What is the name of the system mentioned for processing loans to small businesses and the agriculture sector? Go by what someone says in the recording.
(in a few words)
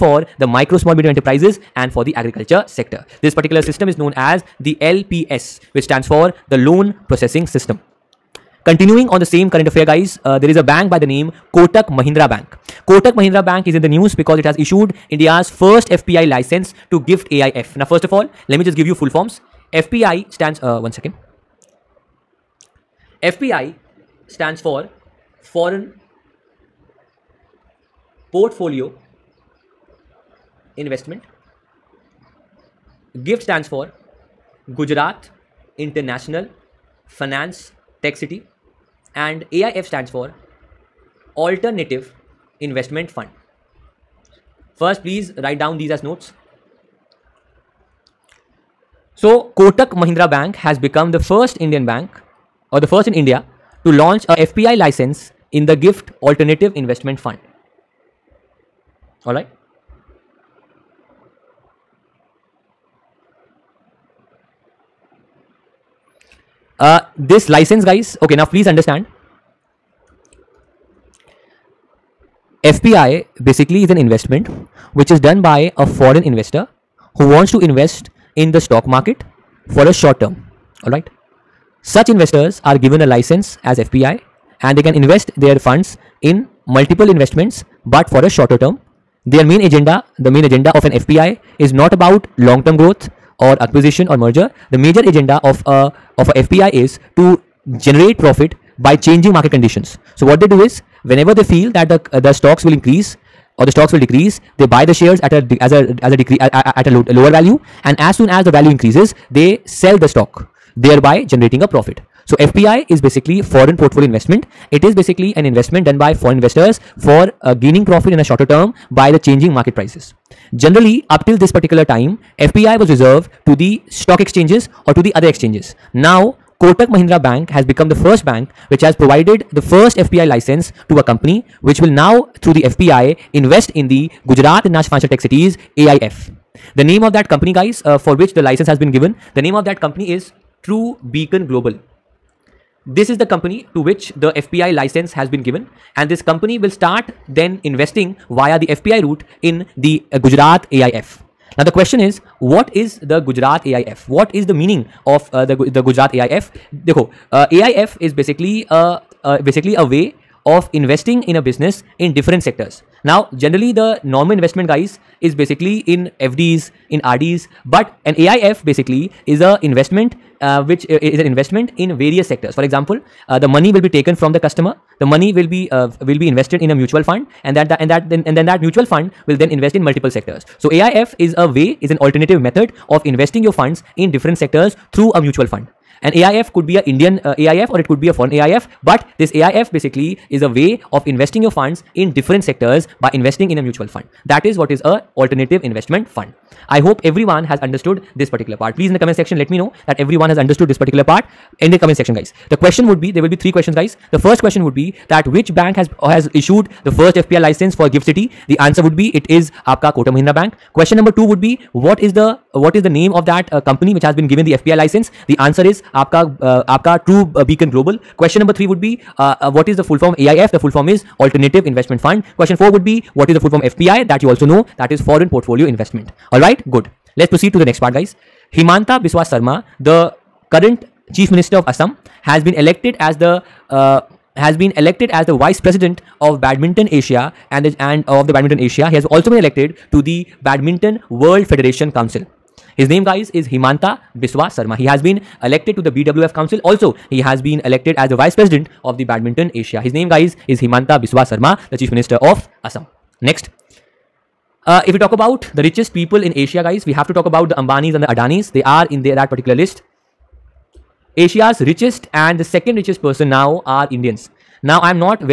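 Loan Processing System.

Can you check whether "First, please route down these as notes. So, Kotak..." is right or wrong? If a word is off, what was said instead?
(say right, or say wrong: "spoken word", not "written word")
wrong: "write", not "route".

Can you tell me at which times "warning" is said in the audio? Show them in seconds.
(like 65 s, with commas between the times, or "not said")
not said.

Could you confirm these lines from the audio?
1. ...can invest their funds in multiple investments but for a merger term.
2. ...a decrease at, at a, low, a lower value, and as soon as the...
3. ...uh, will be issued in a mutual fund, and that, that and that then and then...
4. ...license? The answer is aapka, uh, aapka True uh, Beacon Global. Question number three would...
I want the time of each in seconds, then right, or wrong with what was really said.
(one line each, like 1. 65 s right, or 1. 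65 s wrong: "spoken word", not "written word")
1. 84 s wrong: "shorter", not "merger"
2. 106 s right
3. 175 s wrong: "invested", not "issued"
4. 214 s right.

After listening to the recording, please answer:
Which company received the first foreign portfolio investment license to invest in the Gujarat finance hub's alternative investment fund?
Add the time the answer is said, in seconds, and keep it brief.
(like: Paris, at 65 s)
True Beacon Global, at 140 s.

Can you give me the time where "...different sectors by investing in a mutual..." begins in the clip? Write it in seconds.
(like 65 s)
192 s.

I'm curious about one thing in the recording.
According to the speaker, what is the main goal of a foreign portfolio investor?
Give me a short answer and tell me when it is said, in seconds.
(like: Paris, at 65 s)
Generate profit by changing market conditions, at 97 s.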